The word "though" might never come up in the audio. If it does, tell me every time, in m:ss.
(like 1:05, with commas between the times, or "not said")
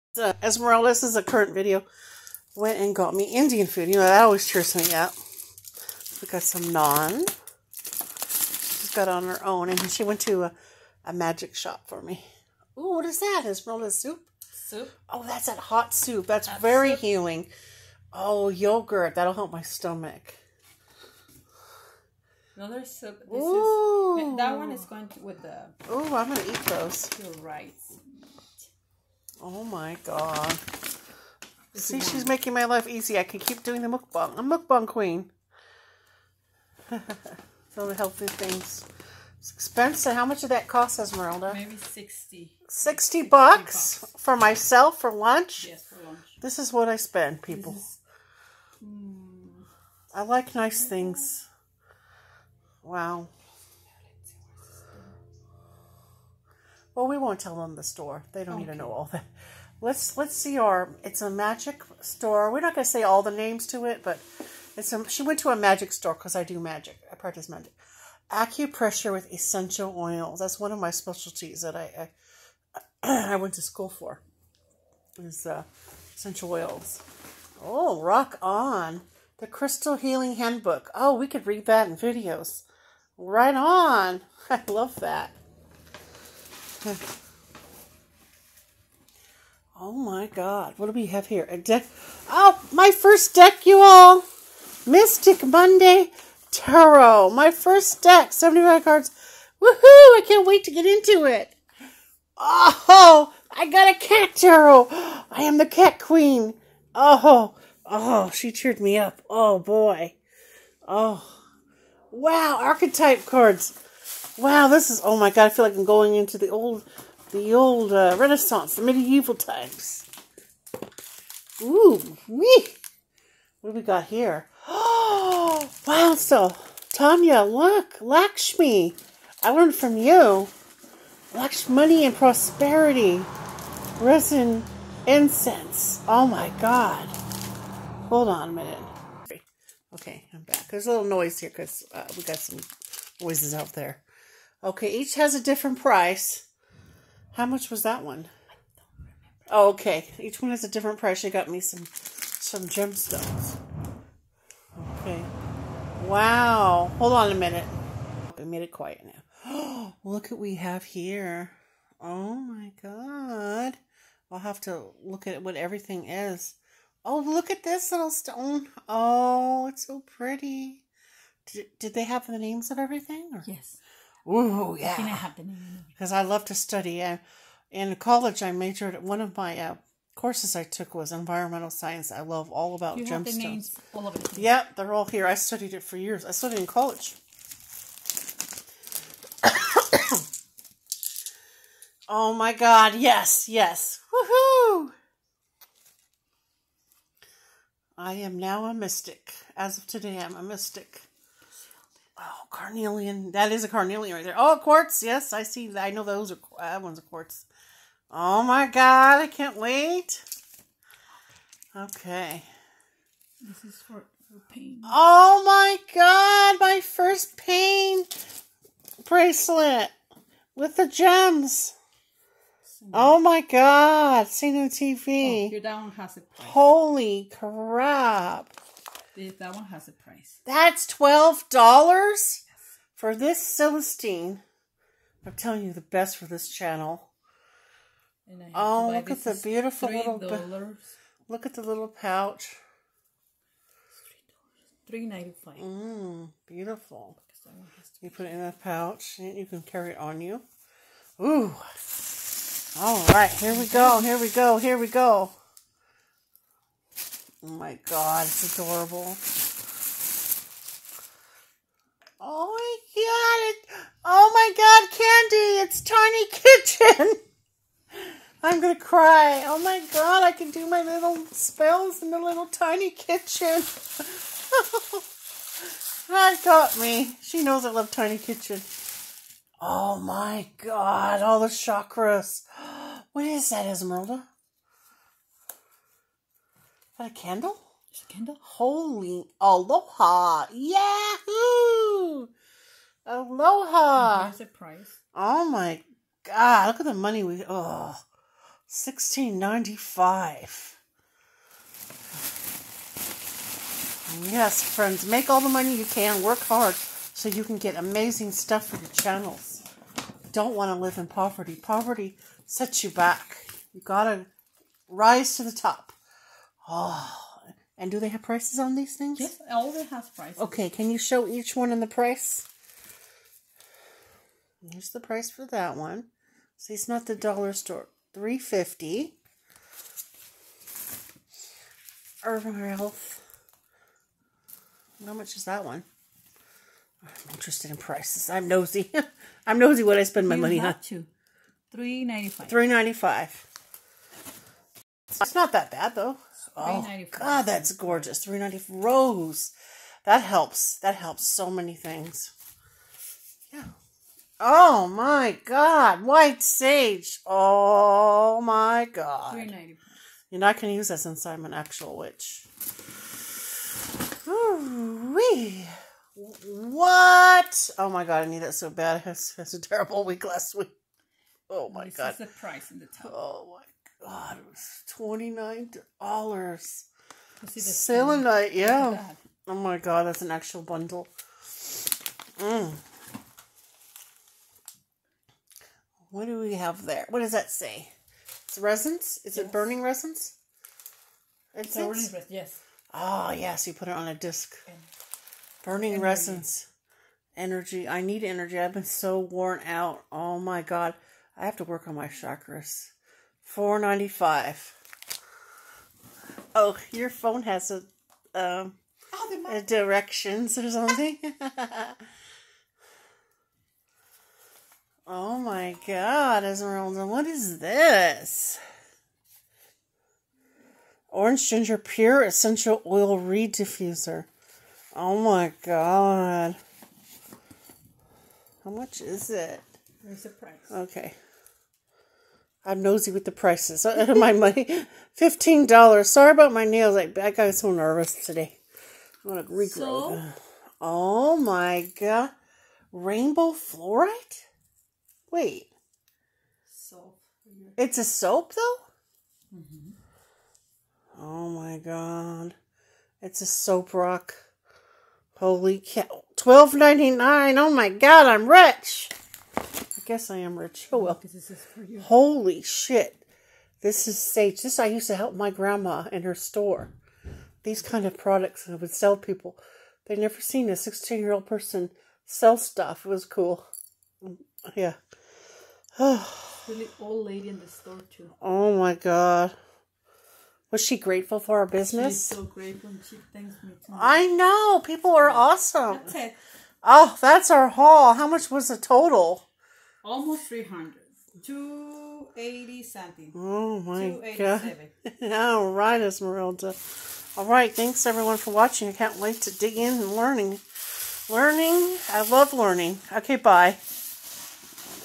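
5:45, 7:28.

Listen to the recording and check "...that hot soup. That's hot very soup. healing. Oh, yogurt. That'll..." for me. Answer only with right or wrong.
right.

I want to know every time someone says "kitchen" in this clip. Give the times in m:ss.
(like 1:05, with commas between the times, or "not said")
4:27, 4:32, 4:38.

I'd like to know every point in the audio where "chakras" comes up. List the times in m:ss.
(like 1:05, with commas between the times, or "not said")
4:41, 6:42.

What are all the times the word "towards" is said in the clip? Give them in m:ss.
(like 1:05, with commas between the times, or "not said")
not said.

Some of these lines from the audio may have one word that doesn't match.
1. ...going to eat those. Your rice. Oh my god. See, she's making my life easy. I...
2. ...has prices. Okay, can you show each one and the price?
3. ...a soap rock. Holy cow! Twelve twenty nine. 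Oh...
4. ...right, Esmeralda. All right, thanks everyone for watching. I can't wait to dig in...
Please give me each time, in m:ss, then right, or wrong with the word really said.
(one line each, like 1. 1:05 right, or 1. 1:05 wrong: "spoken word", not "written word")
1. 0:26 right
2. 5:19 right
3. 7:33 wrong: "ninety", not "twenty"
4. 8:15 right.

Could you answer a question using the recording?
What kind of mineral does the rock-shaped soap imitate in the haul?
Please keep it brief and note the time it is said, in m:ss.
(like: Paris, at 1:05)
Rainbow fluorite, at 7:22.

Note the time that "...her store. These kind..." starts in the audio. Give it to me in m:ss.
7:46.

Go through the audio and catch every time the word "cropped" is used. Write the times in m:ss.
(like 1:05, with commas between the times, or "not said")
not said.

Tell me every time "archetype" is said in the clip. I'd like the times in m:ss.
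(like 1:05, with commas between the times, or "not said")
1:52.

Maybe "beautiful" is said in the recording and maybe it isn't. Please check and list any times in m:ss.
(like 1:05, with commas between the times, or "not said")
3:59, 4:06.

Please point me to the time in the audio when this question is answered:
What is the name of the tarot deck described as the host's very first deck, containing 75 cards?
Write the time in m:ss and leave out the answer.
1:34.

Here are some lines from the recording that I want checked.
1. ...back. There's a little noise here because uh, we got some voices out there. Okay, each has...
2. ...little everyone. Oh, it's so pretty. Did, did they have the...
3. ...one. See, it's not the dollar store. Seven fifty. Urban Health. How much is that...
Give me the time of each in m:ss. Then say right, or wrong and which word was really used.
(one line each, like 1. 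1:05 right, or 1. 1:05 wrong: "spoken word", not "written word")
1. 2:20 right
2. 2:47 wrong: "stone", not "everyone"
3. 5:25 wrong: "Three", not "Seven".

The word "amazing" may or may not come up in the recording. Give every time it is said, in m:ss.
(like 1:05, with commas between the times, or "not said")
5:07.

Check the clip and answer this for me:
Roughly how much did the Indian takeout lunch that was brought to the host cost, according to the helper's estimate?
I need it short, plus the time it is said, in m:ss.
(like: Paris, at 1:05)
60, at 0:41.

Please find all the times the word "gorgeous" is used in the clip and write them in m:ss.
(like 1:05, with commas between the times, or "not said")
5:47.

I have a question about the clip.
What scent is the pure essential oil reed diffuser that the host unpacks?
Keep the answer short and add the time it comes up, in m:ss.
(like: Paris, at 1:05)
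Orange ginger, at 7:01.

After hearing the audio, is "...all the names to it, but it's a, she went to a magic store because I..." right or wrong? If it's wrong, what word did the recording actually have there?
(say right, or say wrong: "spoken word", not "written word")
right.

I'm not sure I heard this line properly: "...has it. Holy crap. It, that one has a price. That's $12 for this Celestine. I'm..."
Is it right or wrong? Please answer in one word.
right.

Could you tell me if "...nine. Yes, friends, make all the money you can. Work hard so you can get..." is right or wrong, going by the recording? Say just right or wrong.
wrong.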